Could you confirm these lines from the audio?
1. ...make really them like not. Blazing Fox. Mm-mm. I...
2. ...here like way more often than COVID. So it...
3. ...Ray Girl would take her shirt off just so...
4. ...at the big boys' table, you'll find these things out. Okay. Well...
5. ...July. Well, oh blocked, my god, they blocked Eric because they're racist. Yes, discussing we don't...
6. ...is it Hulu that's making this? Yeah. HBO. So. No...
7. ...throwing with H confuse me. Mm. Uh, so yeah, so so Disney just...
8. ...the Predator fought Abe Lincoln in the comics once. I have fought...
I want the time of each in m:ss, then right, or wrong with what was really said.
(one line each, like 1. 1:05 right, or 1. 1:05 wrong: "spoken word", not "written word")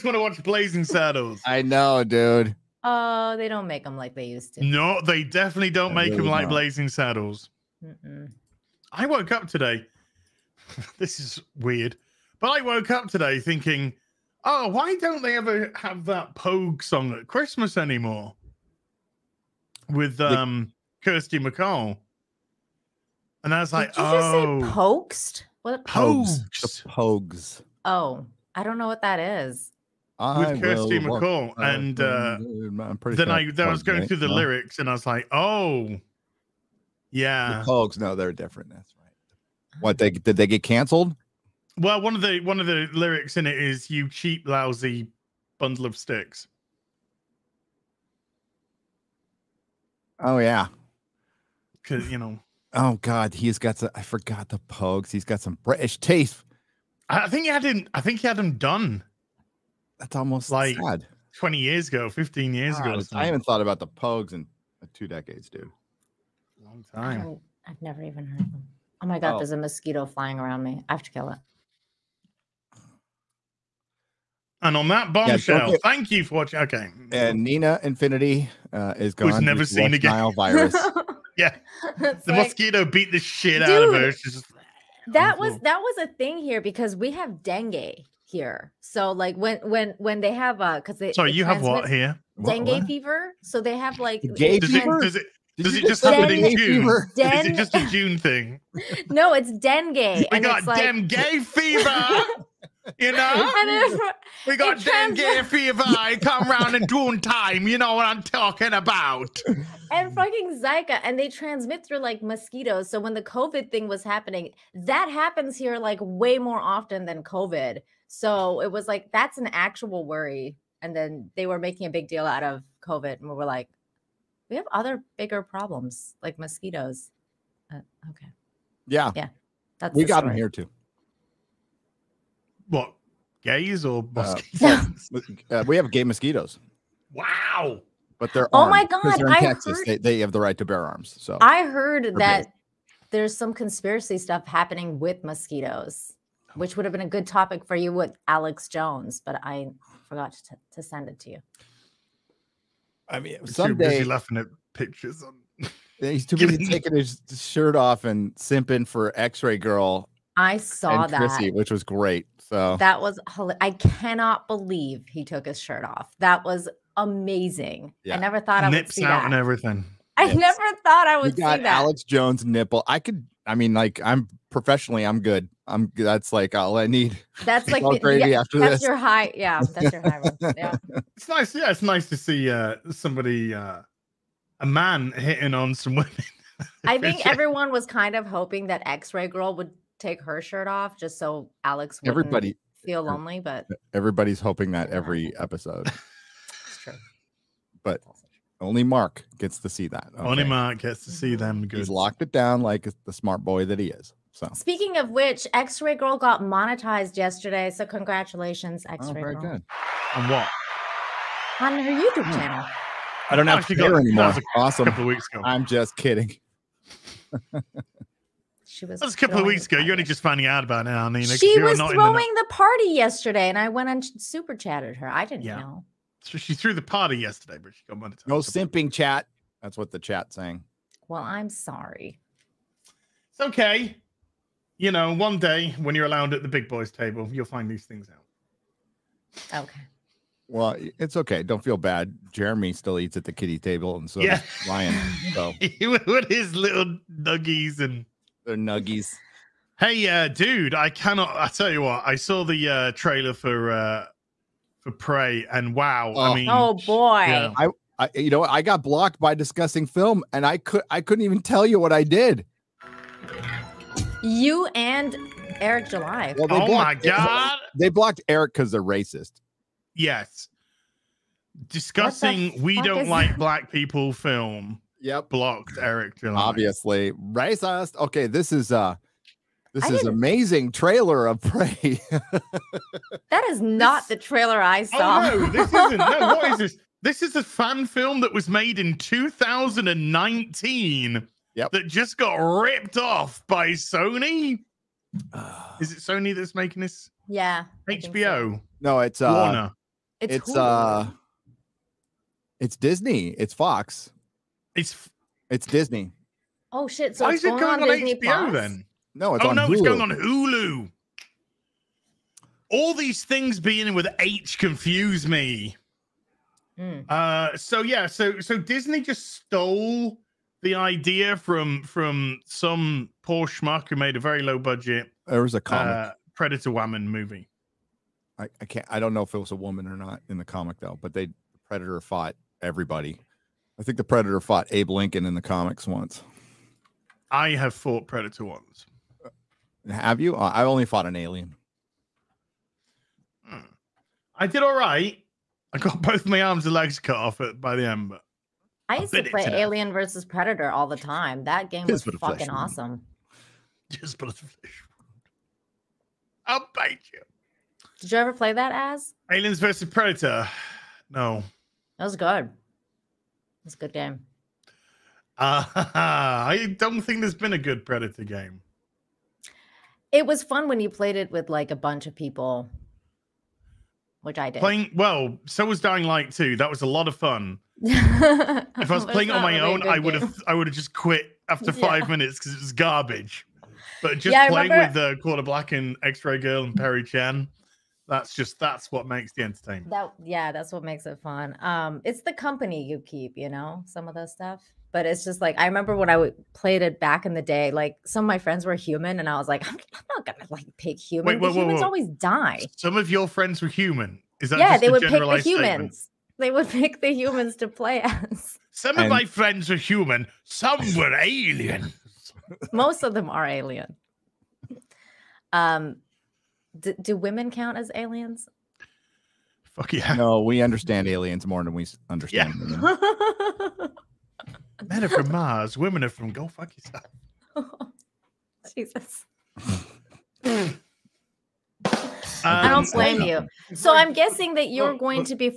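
1. 0:06 wrong: "Saddles", not "Fox"
2. 1:55 right
3. 3:09 right
4. 3:56 right
5. 4:25 right
6. 4:55 wrong: "Sony", not "Hulu"
7. 5:13 wrong: "beginning", not "throwing"
8. 5:33 right.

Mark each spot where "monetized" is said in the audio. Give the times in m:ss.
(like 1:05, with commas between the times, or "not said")
3:26, 3:47.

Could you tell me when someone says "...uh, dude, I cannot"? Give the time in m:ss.
4:10.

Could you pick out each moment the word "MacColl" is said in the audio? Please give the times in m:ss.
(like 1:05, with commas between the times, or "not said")
0:21, 0:30.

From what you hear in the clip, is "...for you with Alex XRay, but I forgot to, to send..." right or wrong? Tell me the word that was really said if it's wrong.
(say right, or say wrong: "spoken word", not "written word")
wrong: "Jones", not "XRay".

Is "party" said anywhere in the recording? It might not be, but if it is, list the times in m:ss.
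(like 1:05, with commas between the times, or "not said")
3:42, 3:46.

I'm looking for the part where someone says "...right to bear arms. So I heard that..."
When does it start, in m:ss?
2:20.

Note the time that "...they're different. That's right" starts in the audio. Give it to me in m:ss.
0:38.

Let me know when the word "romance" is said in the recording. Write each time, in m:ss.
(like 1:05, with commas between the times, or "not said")
not said.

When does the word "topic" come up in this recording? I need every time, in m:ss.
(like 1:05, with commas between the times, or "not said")
2:27.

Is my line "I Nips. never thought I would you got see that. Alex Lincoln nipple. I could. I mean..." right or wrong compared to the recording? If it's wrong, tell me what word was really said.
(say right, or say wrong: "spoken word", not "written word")
wrong: "Jones", not "Lincoln".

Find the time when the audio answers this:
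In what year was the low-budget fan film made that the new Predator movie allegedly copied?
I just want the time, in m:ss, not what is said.
4:48.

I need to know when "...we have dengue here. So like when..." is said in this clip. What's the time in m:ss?
1:26.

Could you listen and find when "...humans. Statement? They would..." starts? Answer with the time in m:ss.
6:45.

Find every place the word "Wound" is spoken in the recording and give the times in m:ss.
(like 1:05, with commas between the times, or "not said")
5:52.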